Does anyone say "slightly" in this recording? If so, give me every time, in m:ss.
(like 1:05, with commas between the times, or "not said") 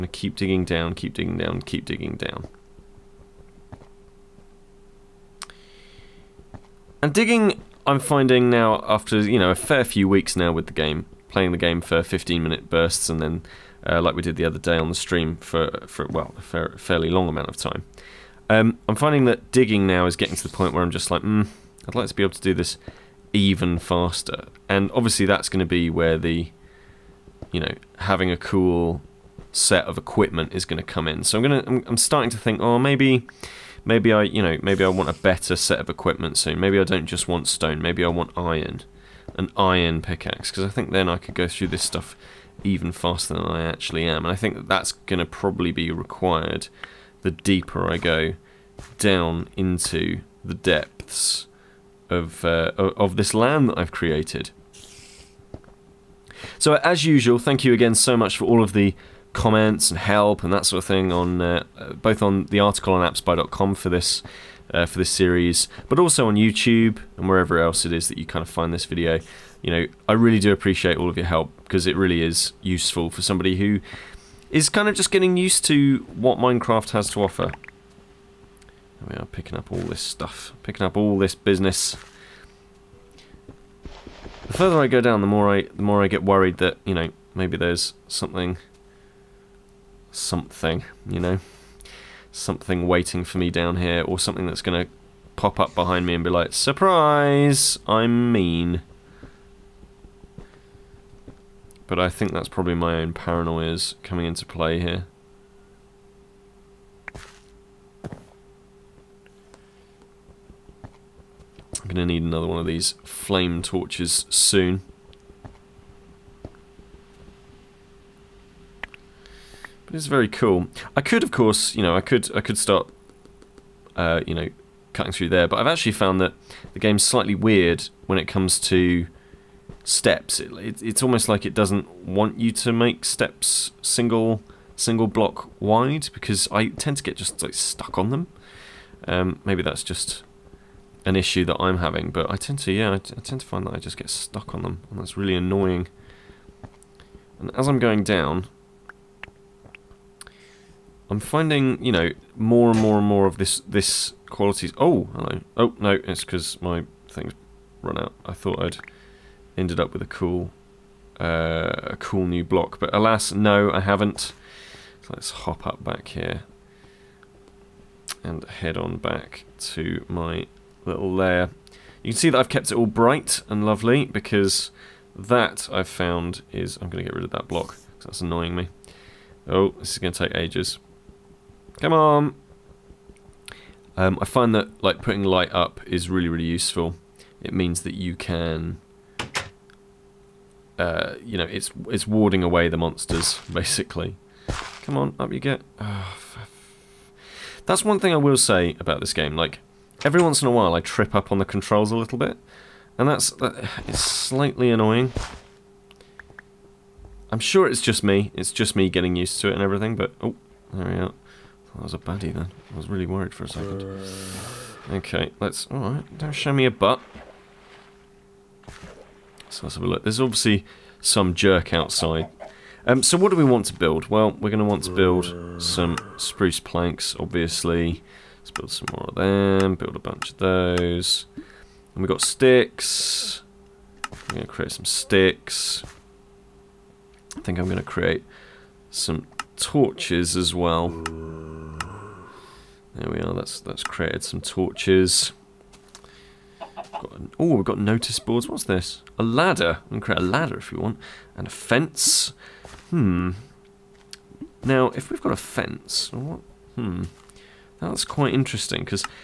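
2:07, 3:23.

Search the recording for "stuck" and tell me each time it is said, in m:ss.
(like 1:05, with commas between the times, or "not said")
2:17, 2:24.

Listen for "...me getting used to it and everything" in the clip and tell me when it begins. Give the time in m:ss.
3:28.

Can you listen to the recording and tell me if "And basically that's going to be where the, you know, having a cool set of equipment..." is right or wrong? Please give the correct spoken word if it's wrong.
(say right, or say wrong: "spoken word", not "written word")
wrong: "obviously", not "basically".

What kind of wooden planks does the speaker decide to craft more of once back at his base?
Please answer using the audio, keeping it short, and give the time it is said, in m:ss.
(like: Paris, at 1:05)
Spruce planks, at 3:46.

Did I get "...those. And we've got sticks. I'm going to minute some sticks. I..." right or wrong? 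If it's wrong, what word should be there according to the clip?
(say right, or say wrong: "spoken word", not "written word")
wrong: "create", not "minute".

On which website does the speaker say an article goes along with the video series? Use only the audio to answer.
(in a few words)
AppSpy.com.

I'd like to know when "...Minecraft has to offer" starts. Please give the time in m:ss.
1:16.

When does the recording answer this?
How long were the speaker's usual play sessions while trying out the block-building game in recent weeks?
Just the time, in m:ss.
0:12.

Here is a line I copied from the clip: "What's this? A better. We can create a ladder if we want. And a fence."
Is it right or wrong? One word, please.
wrong.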